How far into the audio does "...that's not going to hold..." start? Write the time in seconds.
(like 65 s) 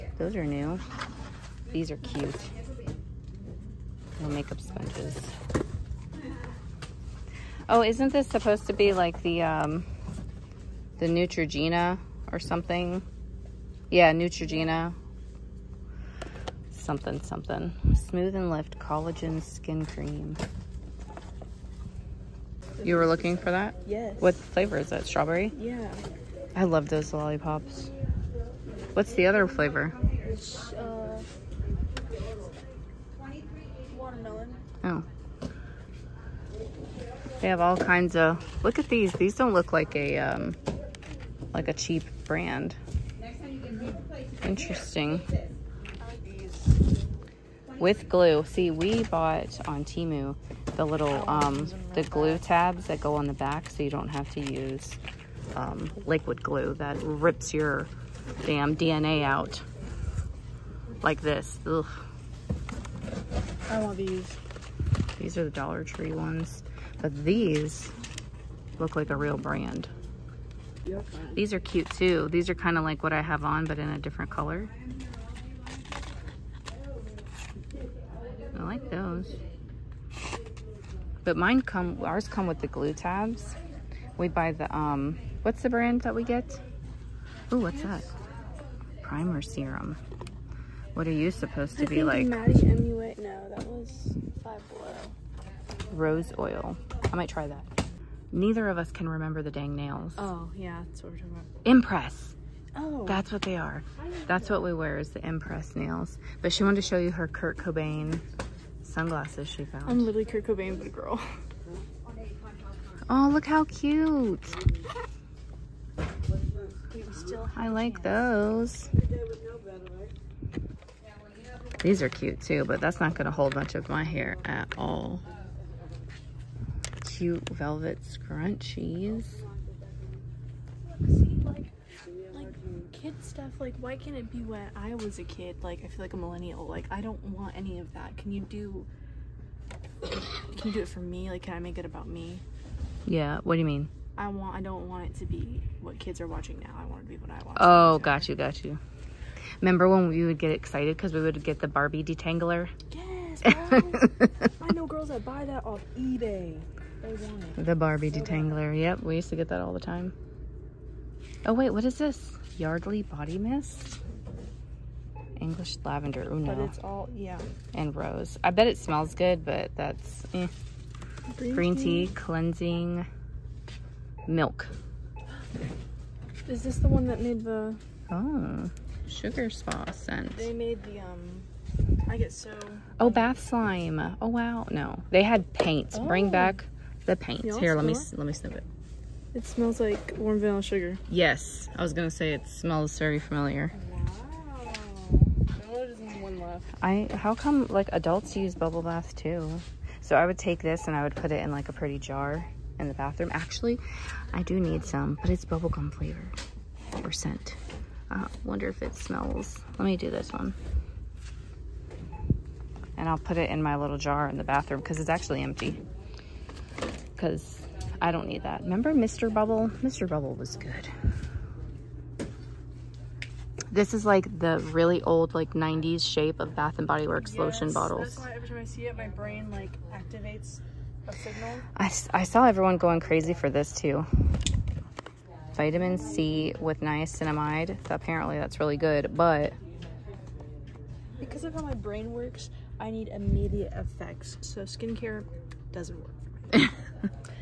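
122 s.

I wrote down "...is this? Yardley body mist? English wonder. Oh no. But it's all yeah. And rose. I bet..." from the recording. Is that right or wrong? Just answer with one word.
wrong.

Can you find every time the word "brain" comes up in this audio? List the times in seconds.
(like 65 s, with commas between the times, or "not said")
229 s, 241 s.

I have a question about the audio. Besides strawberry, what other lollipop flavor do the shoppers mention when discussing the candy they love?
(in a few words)
Watermelon.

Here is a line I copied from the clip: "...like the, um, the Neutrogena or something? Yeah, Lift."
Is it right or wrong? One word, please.
wrong.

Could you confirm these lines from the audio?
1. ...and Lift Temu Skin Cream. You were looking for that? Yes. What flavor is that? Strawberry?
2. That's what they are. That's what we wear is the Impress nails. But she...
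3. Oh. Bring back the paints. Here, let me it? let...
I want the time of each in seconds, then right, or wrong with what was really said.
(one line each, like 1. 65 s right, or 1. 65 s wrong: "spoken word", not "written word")
1. 18 s wrong: "Collagen", not "Temu"
2. 103 s right
3. 185 s right.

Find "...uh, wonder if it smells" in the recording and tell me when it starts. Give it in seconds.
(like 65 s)
208 s.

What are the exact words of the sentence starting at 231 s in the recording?
I, I saw everyone going crazy for this too.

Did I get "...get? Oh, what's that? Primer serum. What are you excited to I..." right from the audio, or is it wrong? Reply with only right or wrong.
wrong.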